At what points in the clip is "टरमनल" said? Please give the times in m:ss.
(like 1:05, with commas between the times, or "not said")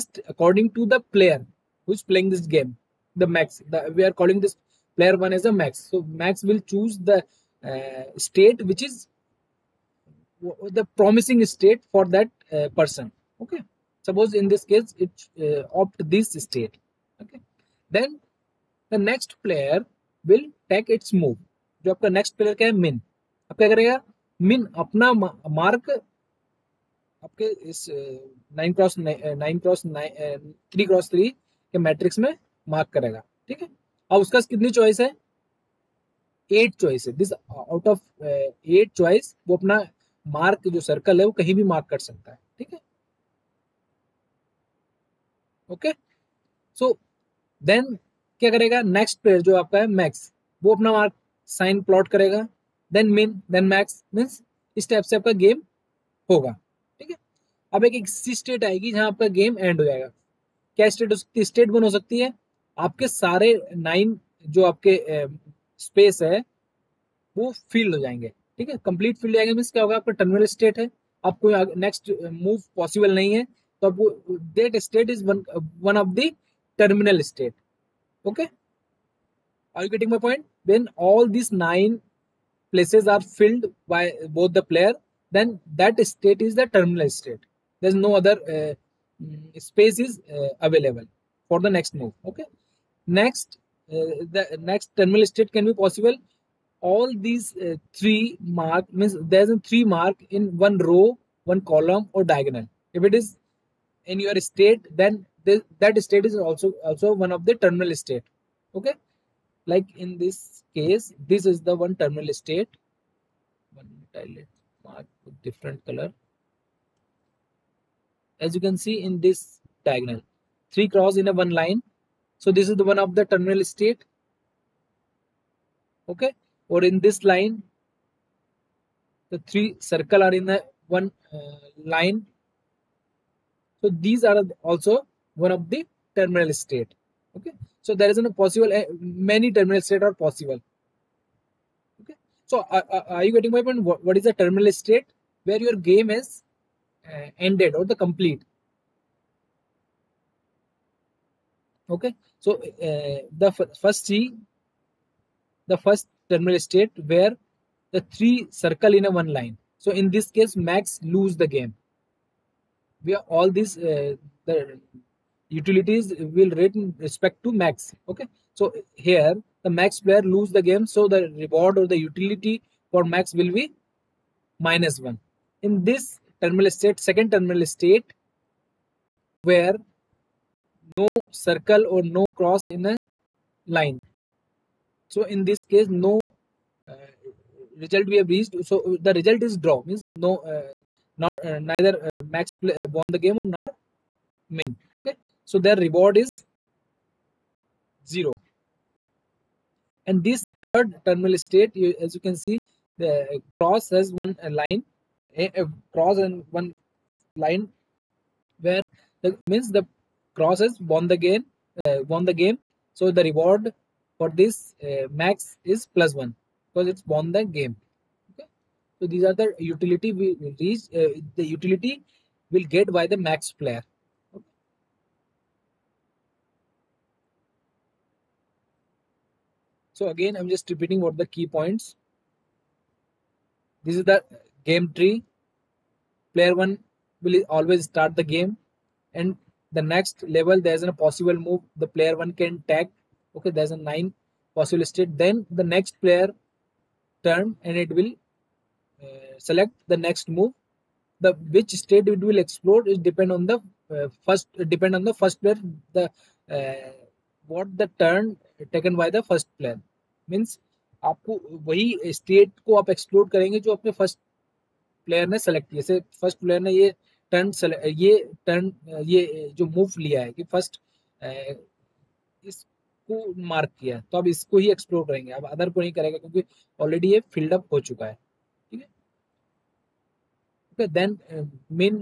1:10, 1:16.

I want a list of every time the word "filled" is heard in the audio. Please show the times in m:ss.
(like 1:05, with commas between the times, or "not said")
1:23.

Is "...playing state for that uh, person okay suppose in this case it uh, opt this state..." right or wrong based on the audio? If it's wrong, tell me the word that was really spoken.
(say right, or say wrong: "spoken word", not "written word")
wrong: "promising", not "playing".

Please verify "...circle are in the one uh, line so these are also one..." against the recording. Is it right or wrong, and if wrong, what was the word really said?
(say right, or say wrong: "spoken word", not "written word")
right.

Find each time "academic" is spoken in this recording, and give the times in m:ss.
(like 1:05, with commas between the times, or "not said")
not said.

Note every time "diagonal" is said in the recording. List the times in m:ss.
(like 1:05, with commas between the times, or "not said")
1:42, 1:59.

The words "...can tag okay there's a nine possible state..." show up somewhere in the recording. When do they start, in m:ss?
4:02.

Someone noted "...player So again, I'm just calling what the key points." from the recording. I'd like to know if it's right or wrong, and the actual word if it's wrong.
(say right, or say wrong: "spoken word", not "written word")
wrong: "repeating", not "calling".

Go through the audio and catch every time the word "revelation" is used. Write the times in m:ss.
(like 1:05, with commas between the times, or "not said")
not said.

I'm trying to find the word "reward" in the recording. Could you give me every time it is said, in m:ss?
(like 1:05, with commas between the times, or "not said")
2:51, 3:15, 3:33.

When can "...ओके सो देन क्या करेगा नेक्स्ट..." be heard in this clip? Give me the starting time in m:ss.
0:45.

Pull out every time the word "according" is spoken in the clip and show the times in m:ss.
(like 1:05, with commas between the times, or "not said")
0:00.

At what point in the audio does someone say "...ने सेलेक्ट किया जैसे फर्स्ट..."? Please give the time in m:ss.
4:25.